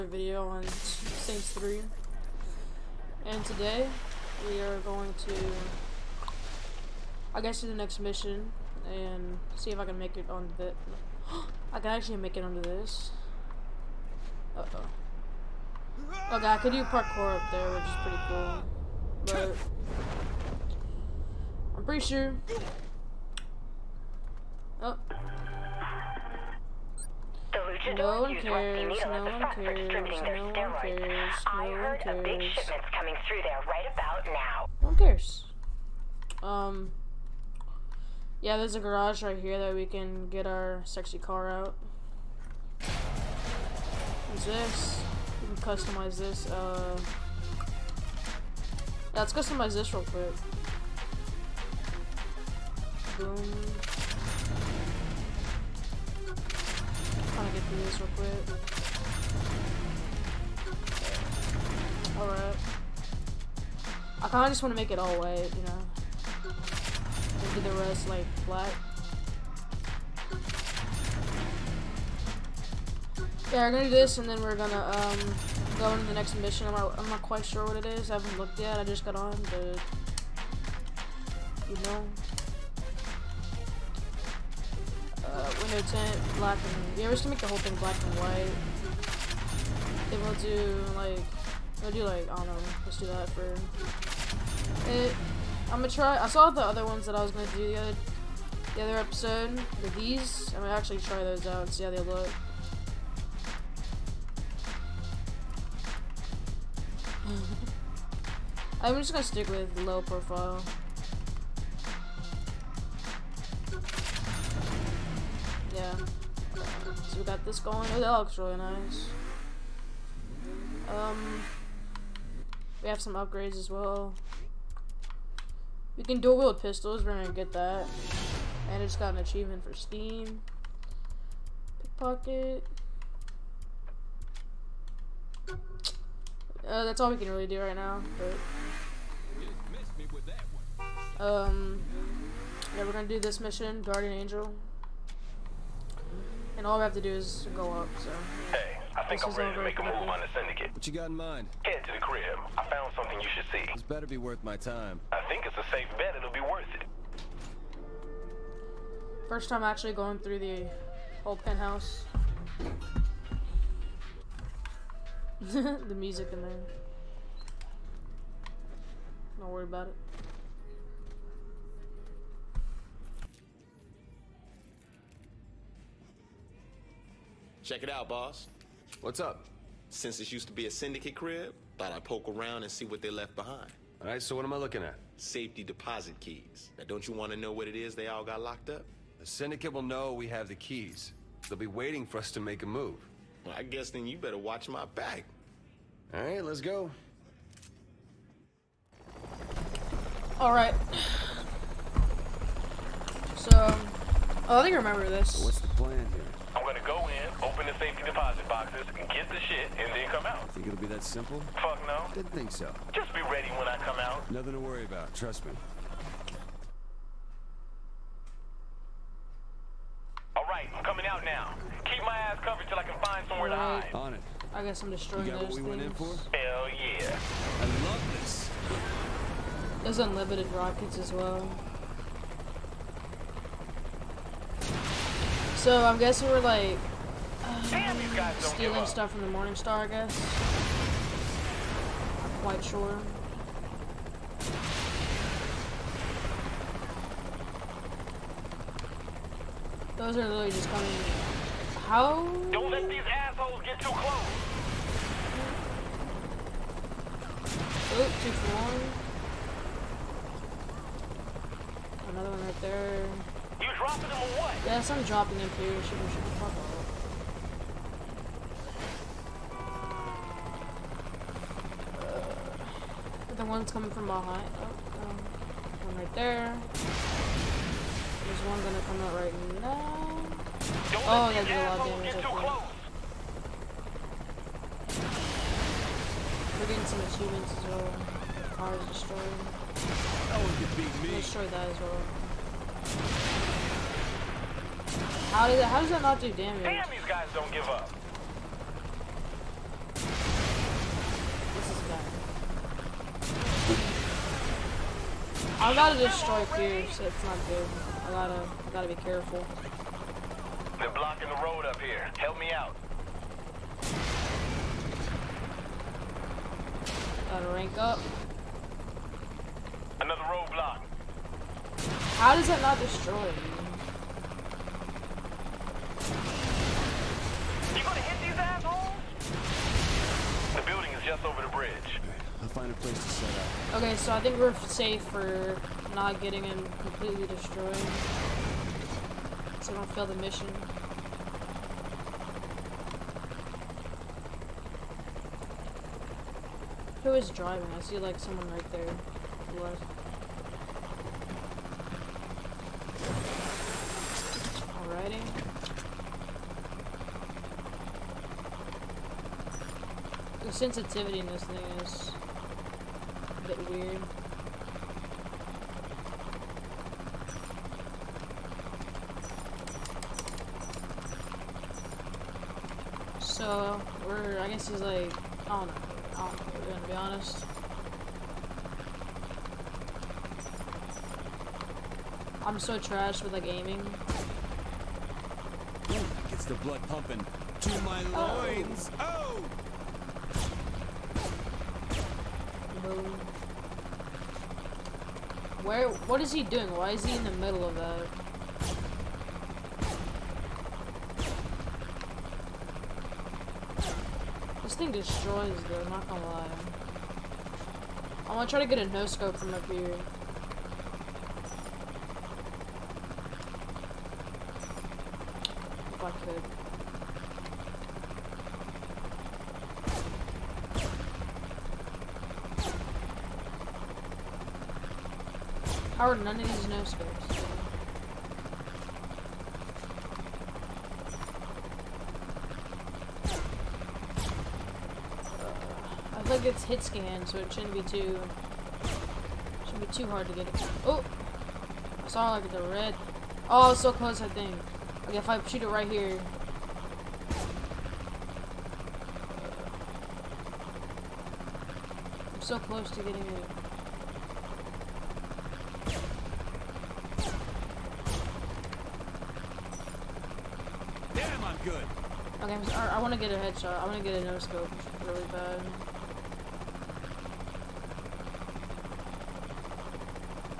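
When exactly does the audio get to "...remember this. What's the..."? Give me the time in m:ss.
3:24.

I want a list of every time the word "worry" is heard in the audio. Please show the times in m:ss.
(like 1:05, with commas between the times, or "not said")
2:49, 3:34.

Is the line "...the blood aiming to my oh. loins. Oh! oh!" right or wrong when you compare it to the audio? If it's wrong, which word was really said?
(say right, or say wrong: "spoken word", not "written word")
wrong: "pumping", not "aiming".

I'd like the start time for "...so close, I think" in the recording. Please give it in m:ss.
7:23.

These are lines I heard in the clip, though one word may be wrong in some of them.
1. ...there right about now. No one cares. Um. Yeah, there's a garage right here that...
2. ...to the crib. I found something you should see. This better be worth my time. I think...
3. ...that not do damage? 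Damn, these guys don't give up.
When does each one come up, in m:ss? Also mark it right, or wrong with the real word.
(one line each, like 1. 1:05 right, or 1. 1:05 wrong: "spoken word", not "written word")
1. 0:33 right
2. 2:31 right
3. 4:55 right.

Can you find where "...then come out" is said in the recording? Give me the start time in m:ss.
3:29.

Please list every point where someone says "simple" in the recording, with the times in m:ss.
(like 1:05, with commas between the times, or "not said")
3:31.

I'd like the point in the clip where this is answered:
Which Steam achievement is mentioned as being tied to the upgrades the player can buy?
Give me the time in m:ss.
2:11.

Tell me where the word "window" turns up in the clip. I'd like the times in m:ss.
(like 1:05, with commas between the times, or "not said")
1:25.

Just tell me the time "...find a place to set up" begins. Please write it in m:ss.
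5:32.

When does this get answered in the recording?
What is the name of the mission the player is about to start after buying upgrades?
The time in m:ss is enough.
2:23.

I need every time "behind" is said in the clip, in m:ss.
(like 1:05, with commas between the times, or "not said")
3:03, 4:34.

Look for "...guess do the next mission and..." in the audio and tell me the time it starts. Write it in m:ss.
0:07.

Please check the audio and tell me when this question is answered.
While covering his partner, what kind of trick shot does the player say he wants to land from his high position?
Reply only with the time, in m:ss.
6:48.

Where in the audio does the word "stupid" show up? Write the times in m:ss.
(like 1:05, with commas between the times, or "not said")
not said.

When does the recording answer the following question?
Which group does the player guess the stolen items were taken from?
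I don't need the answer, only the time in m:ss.
3:59.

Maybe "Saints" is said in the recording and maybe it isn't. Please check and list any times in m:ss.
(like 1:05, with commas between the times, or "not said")
0:00.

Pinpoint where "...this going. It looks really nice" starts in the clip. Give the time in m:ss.
1:57.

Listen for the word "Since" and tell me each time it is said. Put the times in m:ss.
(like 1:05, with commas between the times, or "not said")
2:59.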